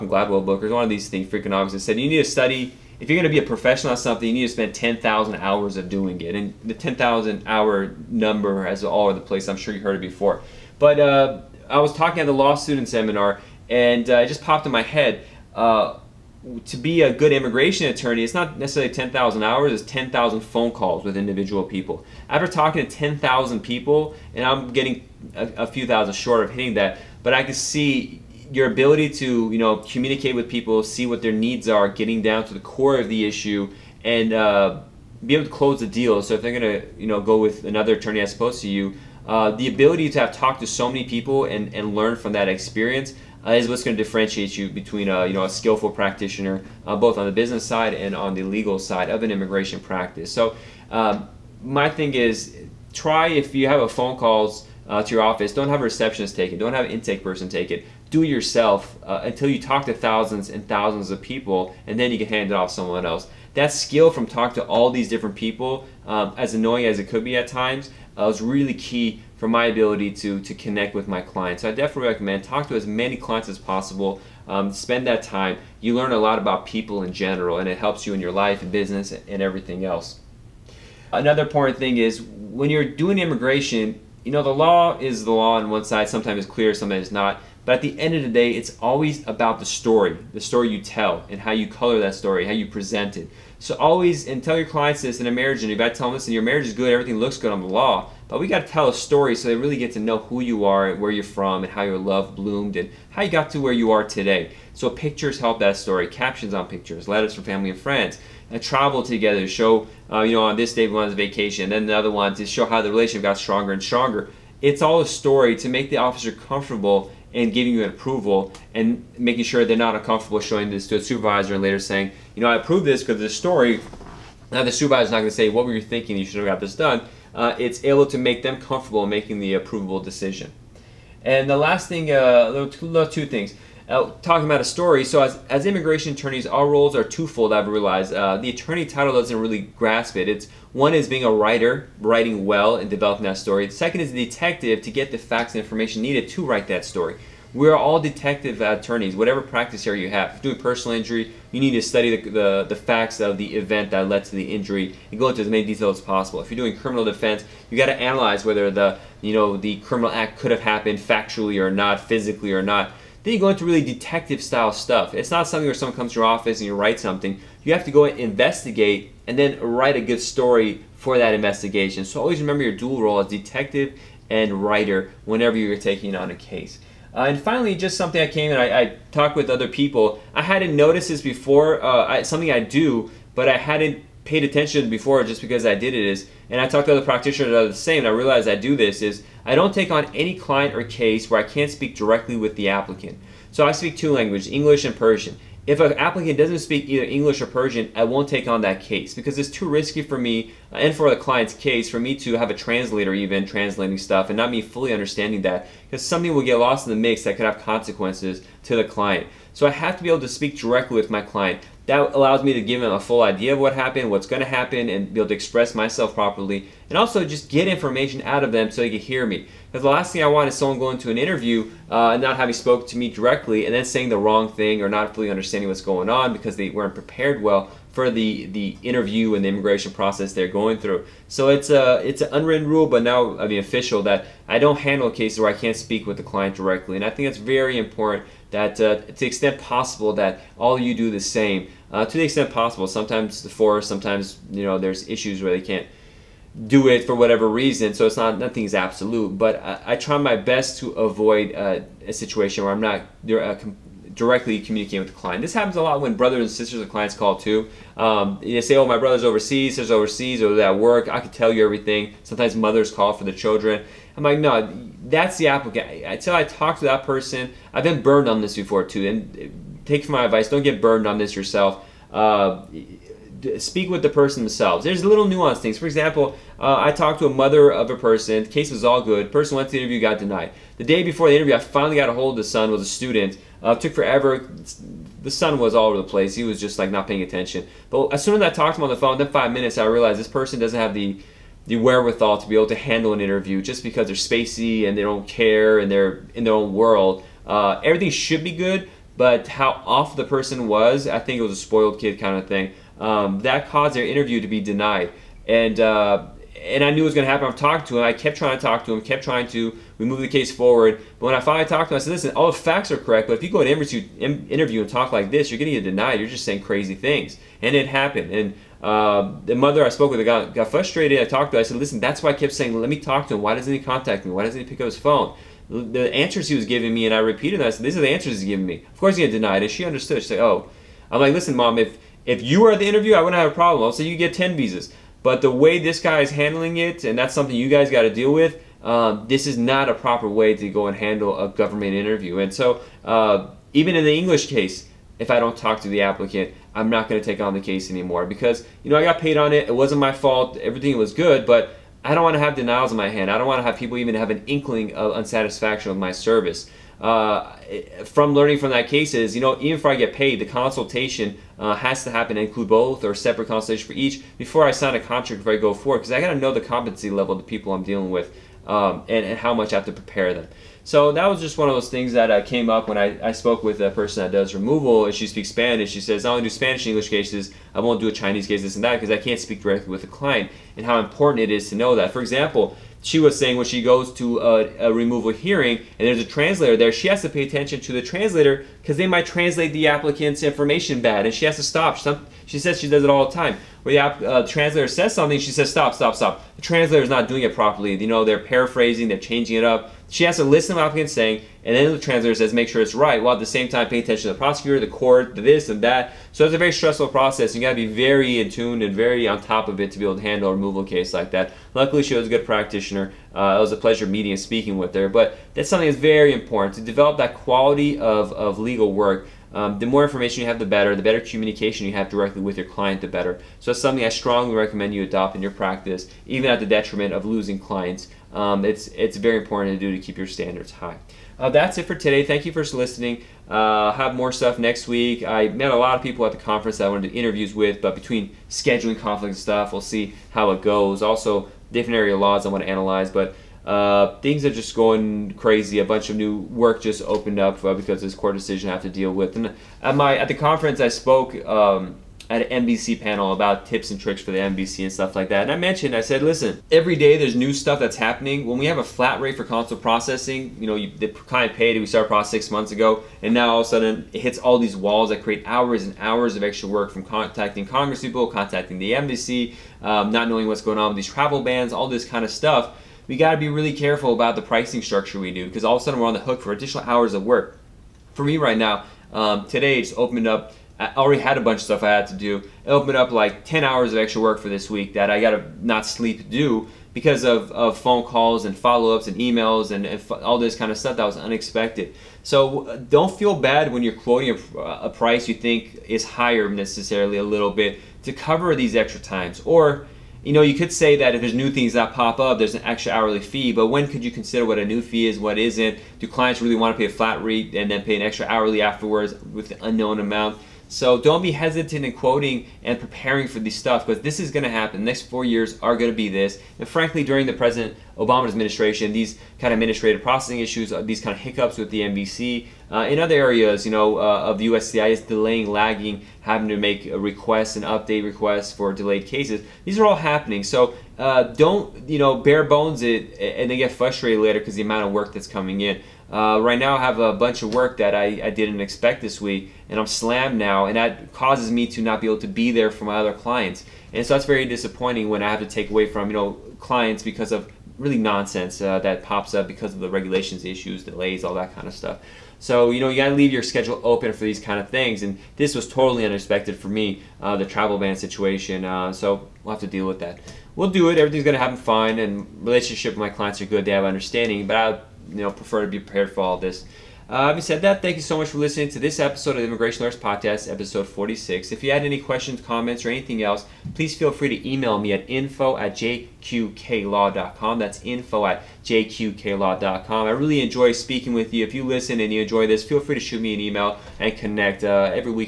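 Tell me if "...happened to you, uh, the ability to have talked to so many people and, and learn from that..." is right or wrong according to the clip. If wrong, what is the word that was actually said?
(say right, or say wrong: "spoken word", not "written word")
wrong: "opposed", not "happened".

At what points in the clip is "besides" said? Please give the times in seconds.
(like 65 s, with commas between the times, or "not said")
not said.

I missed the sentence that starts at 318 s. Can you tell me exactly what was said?
And uh, the mother I spoke with got, got frustrated.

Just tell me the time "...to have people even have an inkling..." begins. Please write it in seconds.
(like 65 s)
353 s.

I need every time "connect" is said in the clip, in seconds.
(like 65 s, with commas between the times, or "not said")
70 s, 584 s.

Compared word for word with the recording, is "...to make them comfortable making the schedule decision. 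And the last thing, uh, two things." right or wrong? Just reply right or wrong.
wrong.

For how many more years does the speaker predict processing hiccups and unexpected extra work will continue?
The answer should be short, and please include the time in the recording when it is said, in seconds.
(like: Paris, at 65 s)
4 years, at 515 s.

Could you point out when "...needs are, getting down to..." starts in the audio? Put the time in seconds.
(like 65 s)
31 s.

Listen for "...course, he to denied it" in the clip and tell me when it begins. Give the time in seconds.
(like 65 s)
328 s.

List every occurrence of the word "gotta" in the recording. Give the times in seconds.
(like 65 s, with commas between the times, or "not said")
407 s, 552 s.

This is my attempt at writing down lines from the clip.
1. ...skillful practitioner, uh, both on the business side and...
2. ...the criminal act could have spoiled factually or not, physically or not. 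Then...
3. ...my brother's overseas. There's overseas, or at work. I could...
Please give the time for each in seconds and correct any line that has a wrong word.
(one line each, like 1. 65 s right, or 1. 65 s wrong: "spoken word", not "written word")
1. 45 s right
2. 159 s wrong: "happened", not "spoiled"
3. 258 s right.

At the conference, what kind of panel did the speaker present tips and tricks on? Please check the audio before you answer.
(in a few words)
NVC panel.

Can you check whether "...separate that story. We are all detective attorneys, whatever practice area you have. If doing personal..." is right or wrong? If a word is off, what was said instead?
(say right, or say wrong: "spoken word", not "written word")
wrong: "write", not "separate".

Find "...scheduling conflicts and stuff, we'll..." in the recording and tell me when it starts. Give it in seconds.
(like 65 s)
438 s.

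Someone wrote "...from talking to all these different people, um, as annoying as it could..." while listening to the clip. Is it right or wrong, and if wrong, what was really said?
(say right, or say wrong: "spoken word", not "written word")
right.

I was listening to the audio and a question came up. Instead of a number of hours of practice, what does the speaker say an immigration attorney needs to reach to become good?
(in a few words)
10,000 phone calls.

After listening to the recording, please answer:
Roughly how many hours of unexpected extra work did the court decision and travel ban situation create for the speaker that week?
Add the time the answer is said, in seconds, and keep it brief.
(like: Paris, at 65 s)
10 hours, at 483 s.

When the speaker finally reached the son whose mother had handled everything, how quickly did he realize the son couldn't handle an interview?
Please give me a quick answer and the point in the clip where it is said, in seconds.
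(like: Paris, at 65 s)
5 minutes, at 289 s.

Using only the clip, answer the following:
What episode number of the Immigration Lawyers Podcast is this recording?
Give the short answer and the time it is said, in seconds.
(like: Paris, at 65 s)
46, at 570 s.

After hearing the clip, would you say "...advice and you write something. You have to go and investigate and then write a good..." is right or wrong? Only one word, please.
wrong.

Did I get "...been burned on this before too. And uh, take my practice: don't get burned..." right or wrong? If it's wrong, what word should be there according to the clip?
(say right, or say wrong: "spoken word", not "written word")
wrong: "advice", not "practice".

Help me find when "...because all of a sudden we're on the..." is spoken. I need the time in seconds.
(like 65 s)
475 s.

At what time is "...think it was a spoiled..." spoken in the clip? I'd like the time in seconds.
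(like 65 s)
301 s.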